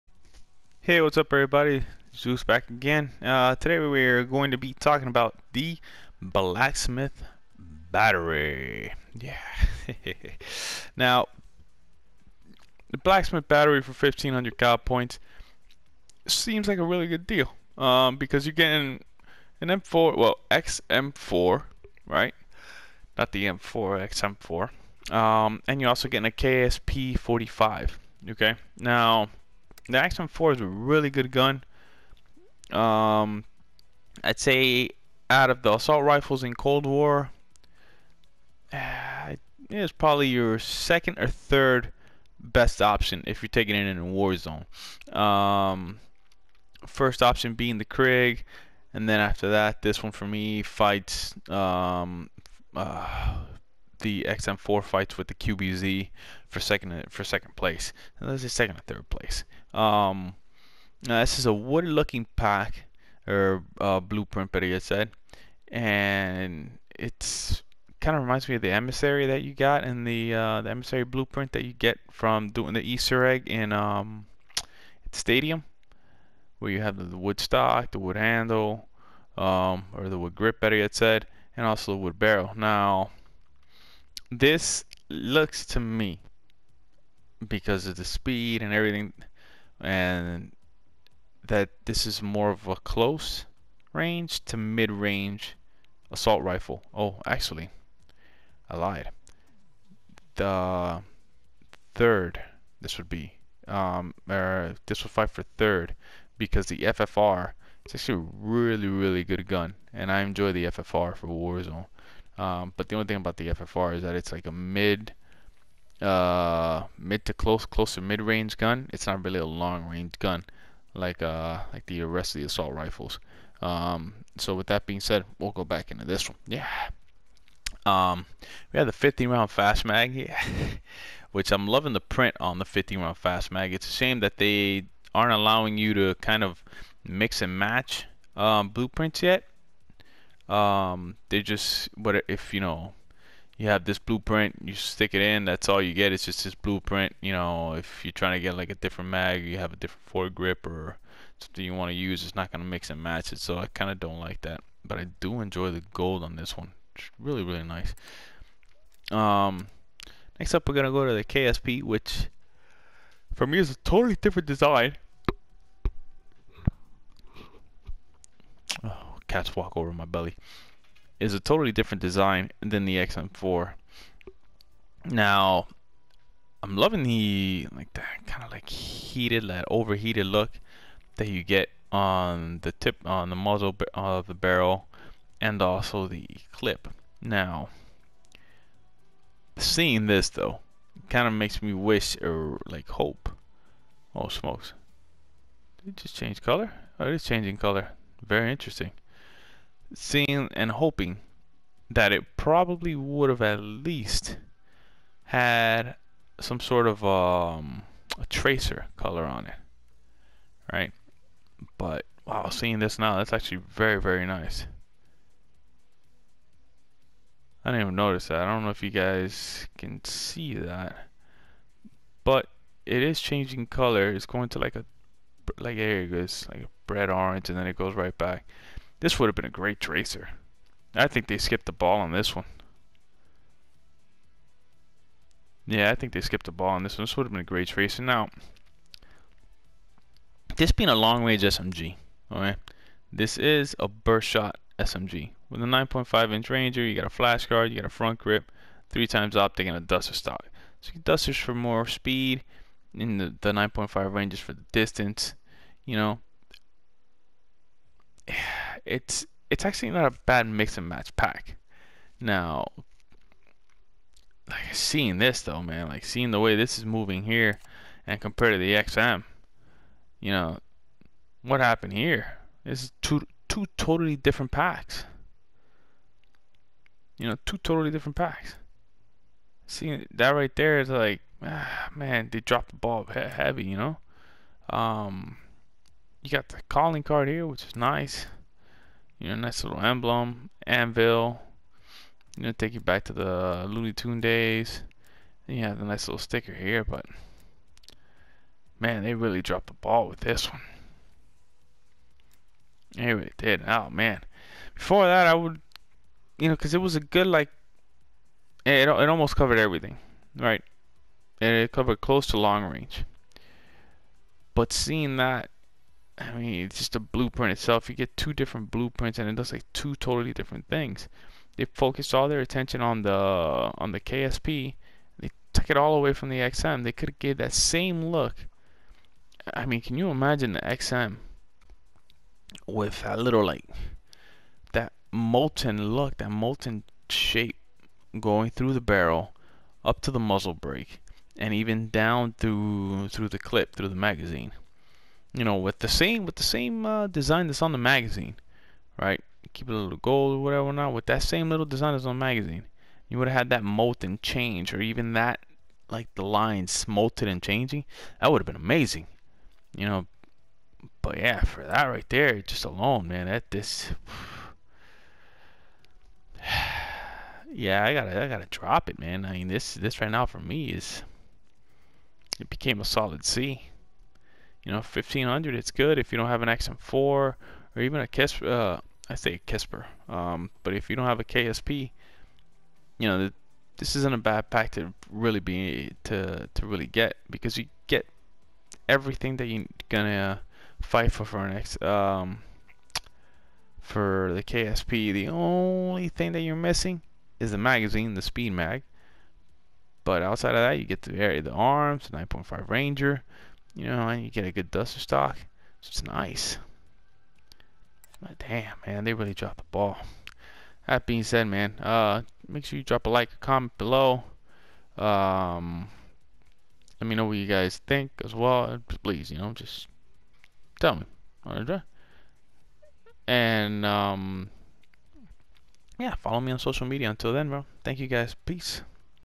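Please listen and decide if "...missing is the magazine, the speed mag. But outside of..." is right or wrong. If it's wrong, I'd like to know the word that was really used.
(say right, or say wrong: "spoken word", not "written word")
right.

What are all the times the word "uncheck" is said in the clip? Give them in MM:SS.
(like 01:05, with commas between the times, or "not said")
not said.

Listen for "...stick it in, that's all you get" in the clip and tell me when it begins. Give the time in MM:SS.
02:24.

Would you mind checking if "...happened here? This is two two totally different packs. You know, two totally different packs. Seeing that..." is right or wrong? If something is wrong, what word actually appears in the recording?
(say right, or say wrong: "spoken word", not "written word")
right.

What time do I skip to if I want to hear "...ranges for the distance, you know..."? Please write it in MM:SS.
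04:14.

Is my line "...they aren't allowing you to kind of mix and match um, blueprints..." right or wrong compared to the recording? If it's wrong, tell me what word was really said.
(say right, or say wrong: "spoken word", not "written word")
right.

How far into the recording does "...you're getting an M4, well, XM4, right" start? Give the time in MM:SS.
00:18.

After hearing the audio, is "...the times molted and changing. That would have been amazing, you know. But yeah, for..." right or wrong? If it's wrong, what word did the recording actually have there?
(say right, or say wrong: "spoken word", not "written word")
wrong: "lines", not "times".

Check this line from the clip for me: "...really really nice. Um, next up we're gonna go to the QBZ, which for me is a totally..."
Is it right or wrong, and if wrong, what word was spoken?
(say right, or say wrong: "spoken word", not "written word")
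wrong: "KSP", not "QBZ".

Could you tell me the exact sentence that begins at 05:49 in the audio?
Keep it a little gold or whatever, not with that same little design that's on the magazine.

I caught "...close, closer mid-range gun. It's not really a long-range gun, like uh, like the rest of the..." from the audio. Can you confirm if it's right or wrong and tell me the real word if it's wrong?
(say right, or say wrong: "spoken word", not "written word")
right.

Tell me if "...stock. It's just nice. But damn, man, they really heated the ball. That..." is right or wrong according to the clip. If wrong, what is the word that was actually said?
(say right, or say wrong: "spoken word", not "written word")
wrong: "dropped", not "heated".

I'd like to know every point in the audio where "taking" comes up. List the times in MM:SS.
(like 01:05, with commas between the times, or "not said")
00:43.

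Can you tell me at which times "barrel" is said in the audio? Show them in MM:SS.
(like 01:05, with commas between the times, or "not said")
01:22, 03:04, 05:38.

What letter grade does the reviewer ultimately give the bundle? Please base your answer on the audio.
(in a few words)
C.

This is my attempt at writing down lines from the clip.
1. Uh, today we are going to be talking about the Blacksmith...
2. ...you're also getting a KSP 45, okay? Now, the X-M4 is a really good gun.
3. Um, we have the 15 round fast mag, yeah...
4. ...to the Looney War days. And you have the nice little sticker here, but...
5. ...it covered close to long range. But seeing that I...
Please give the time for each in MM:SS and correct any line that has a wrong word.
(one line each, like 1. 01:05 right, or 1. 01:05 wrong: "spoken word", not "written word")
1. 00:03 right
2. 00:25 right
3. 02:07 right
4. 04:53 wrong: "Tune", not "War"
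5. 05:11 right.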